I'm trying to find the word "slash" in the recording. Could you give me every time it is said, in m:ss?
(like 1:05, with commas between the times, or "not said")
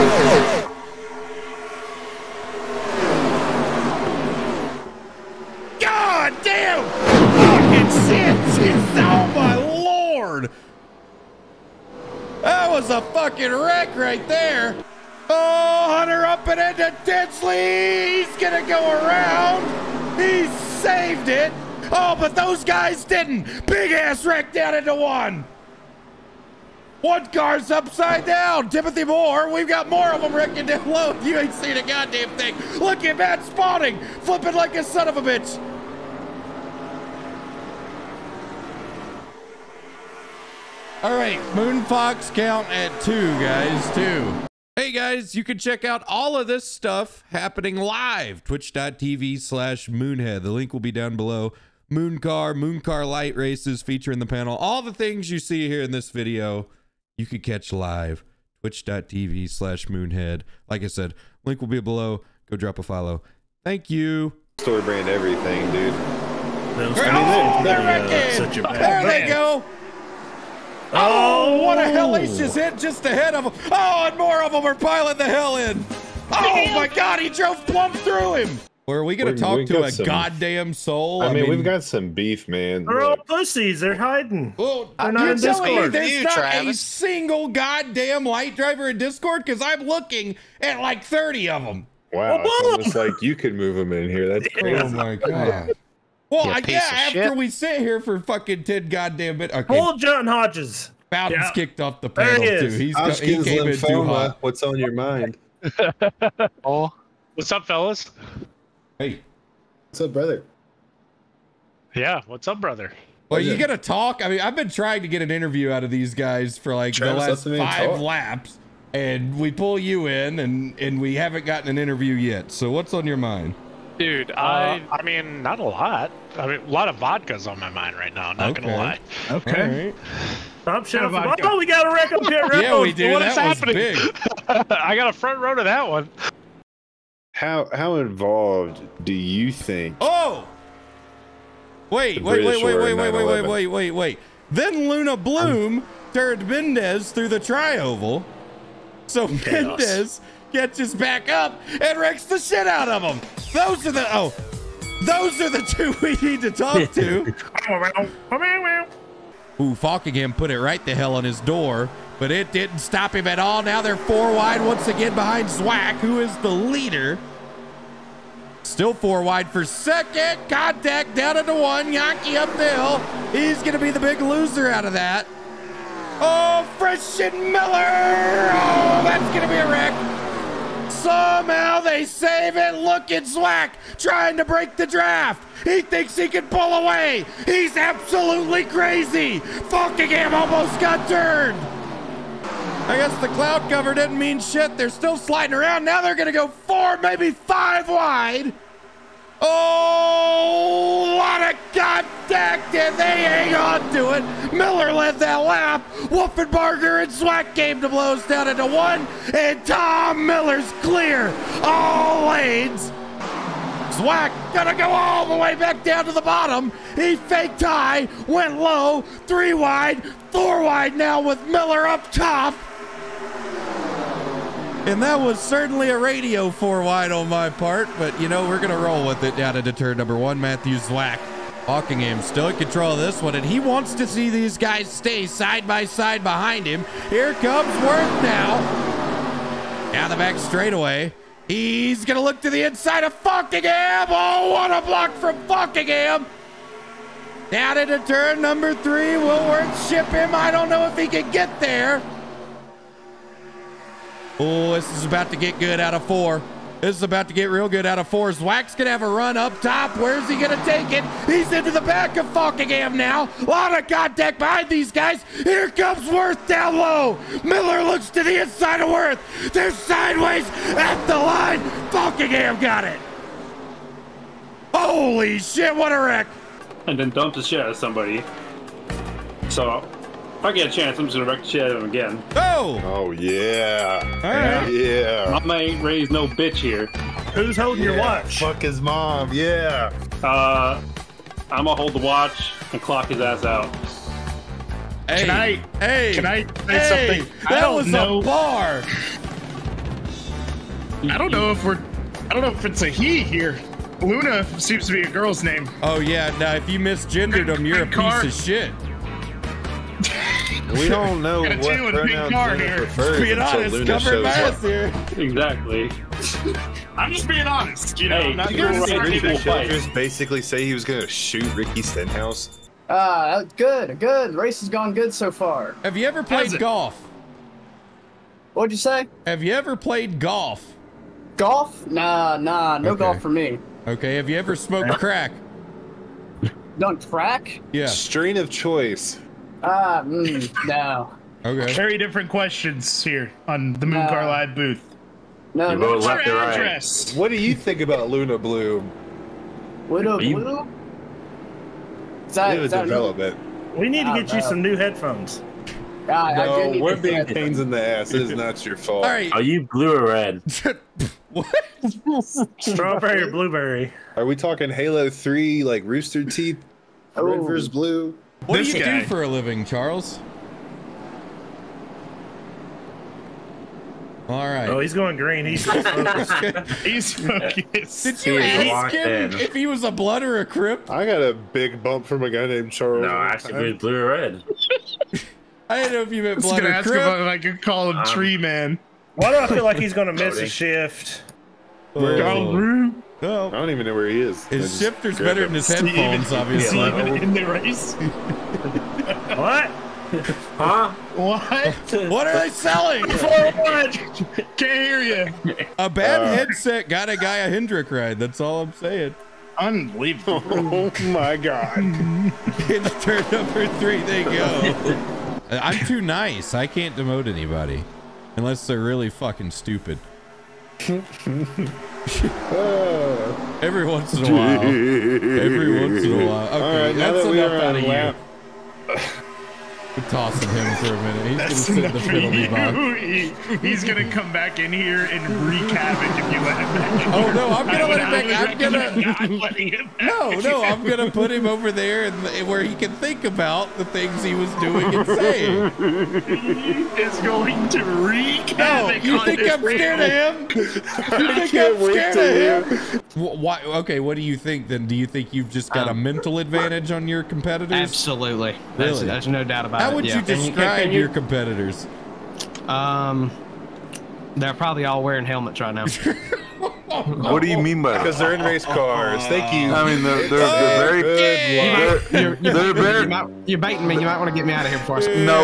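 0:49, 0:59.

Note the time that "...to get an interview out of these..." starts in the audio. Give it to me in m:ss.
1:55.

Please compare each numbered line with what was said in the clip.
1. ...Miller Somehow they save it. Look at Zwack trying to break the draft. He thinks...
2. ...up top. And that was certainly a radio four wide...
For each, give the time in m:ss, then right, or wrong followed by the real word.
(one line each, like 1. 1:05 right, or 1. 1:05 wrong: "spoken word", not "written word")
1. 2:57 right
2. 3:41 right.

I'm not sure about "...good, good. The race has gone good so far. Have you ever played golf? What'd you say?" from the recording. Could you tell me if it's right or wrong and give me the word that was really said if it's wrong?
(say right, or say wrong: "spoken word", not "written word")
right.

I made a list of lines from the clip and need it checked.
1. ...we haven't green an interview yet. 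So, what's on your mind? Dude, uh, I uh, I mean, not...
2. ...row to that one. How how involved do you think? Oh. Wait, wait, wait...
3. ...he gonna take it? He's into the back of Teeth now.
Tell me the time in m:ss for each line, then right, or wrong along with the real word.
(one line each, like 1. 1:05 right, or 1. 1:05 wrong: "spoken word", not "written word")
1. 2:00 wrong: "gotten", not "green"
2. 2:15 right
3. 4:20 wrong: "Falkingham", not "Teeth".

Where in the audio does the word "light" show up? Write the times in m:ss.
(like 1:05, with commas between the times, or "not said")
0:53, 1:28.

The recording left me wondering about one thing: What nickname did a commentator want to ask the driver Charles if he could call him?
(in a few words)
Tree Man.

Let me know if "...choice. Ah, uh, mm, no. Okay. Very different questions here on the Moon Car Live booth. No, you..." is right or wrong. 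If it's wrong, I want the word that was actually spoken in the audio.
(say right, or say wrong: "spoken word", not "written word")
right.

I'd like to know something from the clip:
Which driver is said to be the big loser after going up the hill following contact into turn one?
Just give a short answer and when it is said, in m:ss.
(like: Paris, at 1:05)
Yaki, at 2:51.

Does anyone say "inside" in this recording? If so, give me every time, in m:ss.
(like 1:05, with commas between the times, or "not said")
4:02, 4:28.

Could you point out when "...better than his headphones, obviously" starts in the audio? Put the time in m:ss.
6:35.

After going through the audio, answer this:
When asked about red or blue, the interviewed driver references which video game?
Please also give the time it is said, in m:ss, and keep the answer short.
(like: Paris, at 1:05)
Halo 3, at 6:04.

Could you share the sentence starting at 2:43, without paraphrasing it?
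Now they're four wide once again behind Zwack, who is the leader.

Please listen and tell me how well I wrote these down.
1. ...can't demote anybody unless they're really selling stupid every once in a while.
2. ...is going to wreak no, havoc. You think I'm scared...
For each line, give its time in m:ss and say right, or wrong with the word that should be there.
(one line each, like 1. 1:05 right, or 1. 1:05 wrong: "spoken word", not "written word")
1. 6:56 wrong: "fucking", not "selling"
2. 7:27 right.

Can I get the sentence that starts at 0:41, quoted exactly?
All right, Moon Fox count at two, guys, two.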